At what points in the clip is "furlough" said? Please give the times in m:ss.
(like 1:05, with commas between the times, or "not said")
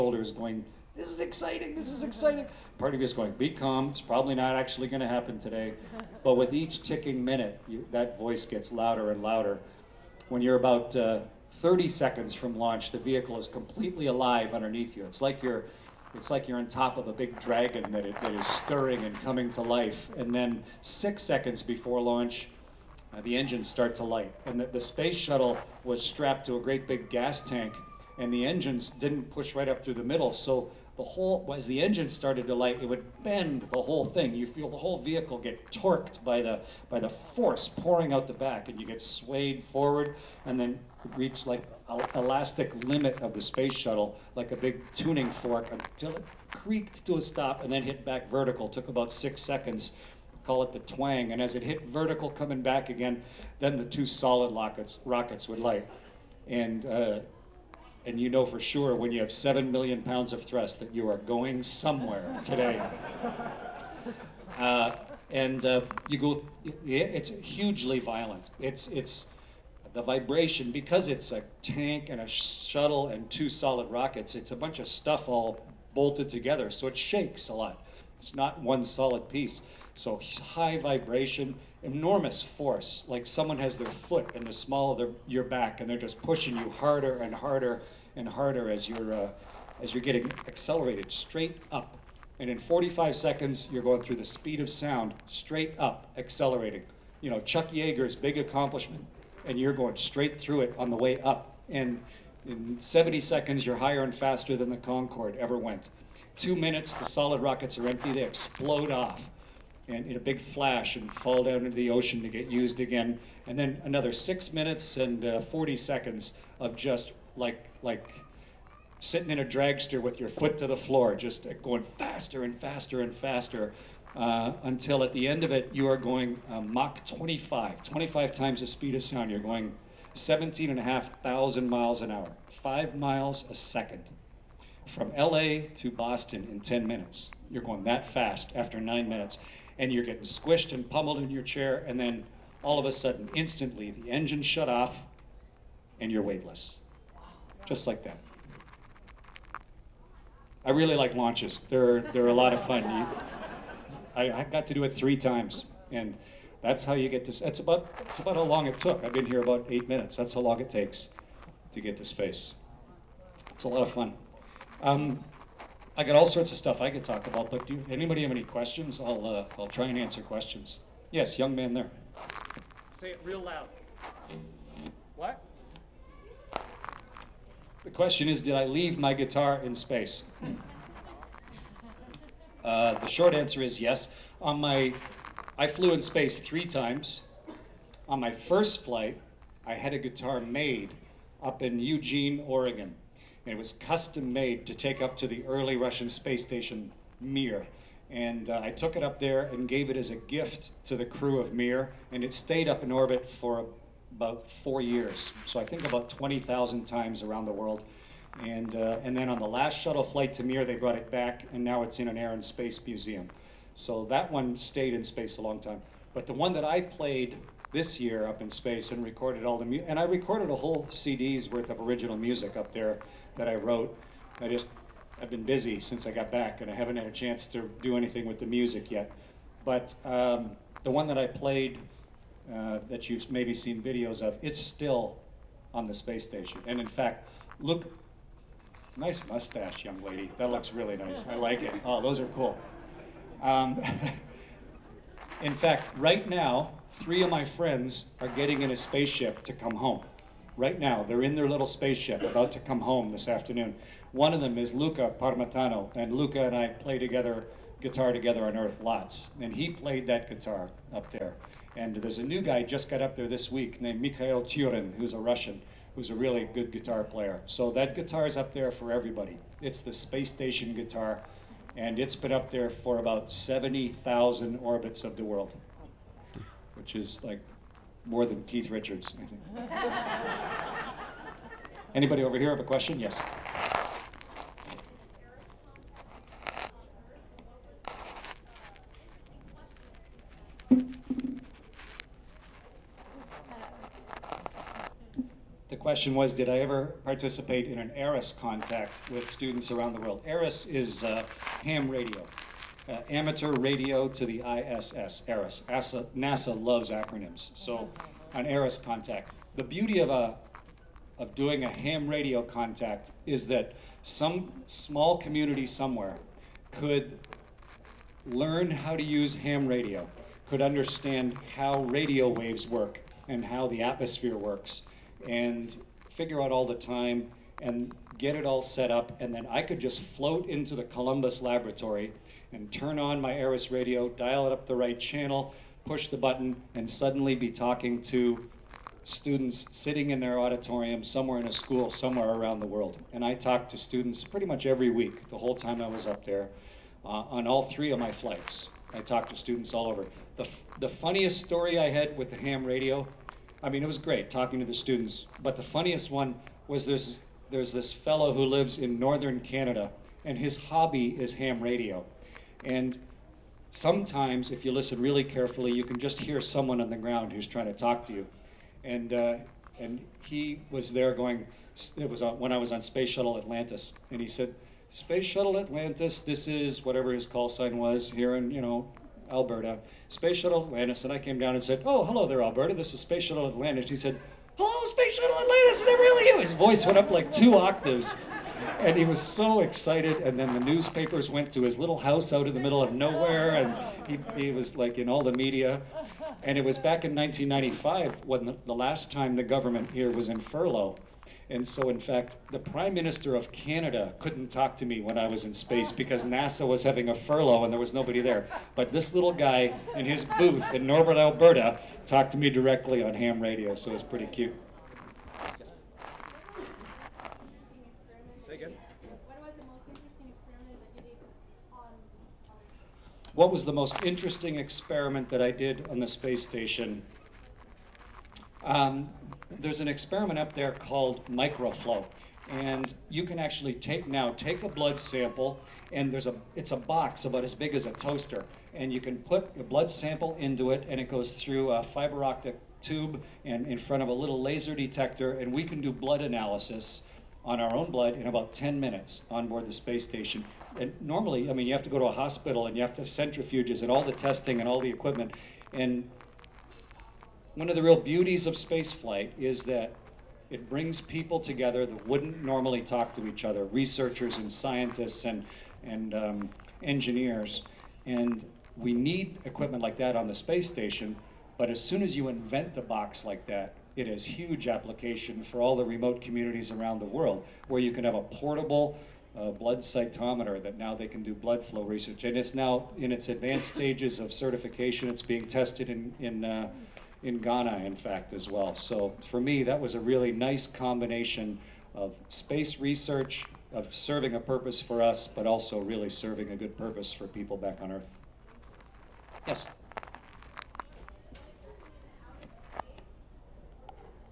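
6:40, 6:47.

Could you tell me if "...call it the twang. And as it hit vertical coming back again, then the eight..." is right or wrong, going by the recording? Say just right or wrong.
wrong.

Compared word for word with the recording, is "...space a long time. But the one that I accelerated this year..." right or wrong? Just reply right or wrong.
wrong.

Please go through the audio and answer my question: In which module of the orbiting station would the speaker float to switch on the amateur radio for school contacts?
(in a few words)
Columbus Laboratory.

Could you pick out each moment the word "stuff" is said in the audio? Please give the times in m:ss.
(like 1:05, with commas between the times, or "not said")
1:14, 2:46.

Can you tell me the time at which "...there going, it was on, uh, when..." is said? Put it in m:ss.
6:10.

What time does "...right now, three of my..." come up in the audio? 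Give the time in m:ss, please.
4:05.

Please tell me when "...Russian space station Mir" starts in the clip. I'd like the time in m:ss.
3:15.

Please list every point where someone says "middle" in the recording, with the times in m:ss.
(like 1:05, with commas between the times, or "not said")
0:30, 6:32.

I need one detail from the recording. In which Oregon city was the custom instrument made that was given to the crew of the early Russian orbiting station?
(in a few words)
Eugene.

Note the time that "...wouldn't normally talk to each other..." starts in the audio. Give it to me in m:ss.
7:42.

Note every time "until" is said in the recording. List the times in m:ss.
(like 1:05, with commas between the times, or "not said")
0:45, 2:04.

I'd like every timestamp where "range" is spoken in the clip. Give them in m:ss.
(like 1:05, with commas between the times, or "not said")
not said.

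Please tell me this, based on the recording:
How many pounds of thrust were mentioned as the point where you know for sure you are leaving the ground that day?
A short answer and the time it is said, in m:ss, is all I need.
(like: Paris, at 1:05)
7 million, at 0:59.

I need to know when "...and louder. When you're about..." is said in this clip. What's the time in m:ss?
0:09.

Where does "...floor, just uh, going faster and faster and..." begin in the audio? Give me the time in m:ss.
2:00.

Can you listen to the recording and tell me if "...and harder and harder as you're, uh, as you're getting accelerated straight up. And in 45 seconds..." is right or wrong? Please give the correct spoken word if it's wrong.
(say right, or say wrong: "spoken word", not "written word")
right.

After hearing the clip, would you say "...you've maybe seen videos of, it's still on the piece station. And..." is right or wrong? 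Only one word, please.
wrong.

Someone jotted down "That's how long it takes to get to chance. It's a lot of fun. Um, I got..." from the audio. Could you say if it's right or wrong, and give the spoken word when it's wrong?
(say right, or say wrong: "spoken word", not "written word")
wrong: "space", not "chance".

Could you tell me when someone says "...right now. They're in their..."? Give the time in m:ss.
4:10.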